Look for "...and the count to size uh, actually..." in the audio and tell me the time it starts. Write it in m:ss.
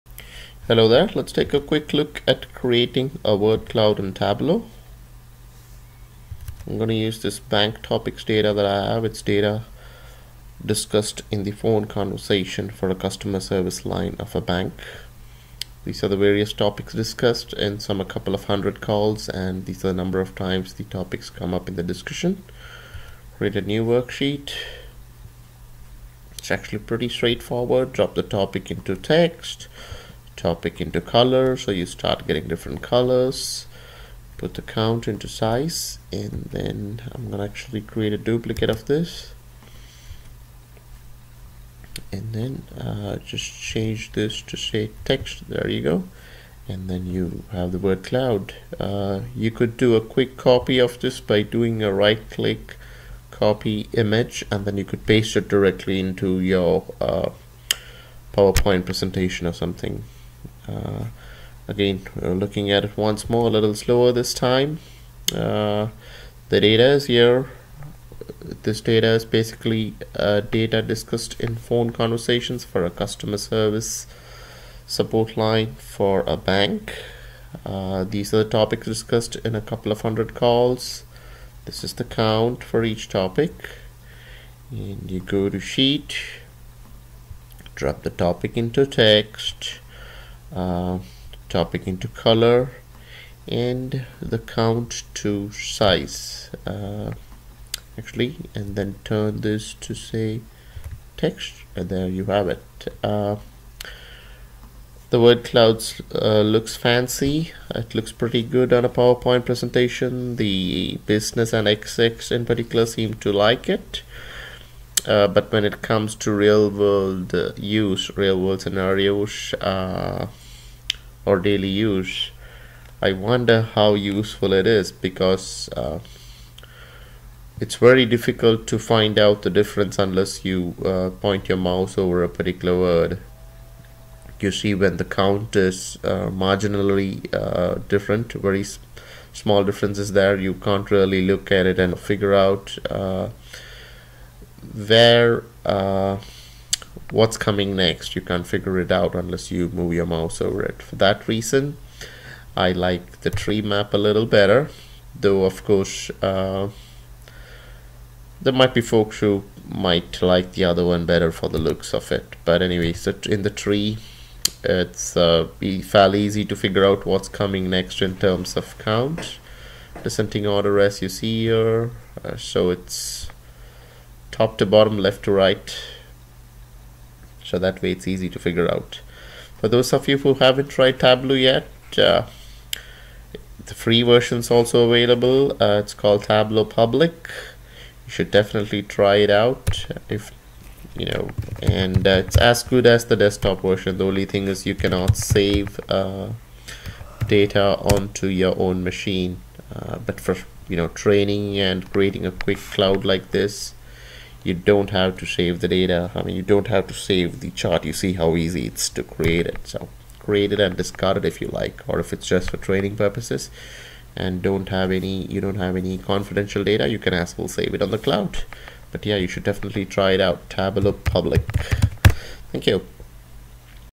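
1:33.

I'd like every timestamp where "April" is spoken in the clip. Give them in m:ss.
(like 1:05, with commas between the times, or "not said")
not said.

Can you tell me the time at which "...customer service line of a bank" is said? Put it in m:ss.
0:12.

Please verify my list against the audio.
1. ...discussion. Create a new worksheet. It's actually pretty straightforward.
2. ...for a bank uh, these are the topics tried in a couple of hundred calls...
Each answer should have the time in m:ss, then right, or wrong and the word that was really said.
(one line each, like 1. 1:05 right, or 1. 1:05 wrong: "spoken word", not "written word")
1. 0:21 right
2. 1:15 wrong: "discussed", not "tried".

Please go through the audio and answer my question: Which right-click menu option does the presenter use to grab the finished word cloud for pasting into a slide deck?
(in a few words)
copy image.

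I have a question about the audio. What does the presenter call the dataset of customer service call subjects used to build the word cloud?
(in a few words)
bank topics data.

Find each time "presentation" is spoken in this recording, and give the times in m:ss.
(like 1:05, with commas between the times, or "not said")
0:58, 1:49.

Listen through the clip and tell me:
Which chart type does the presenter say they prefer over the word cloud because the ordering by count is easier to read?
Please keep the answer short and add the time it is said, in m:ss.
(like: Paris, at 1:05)
tree map, at 2:33.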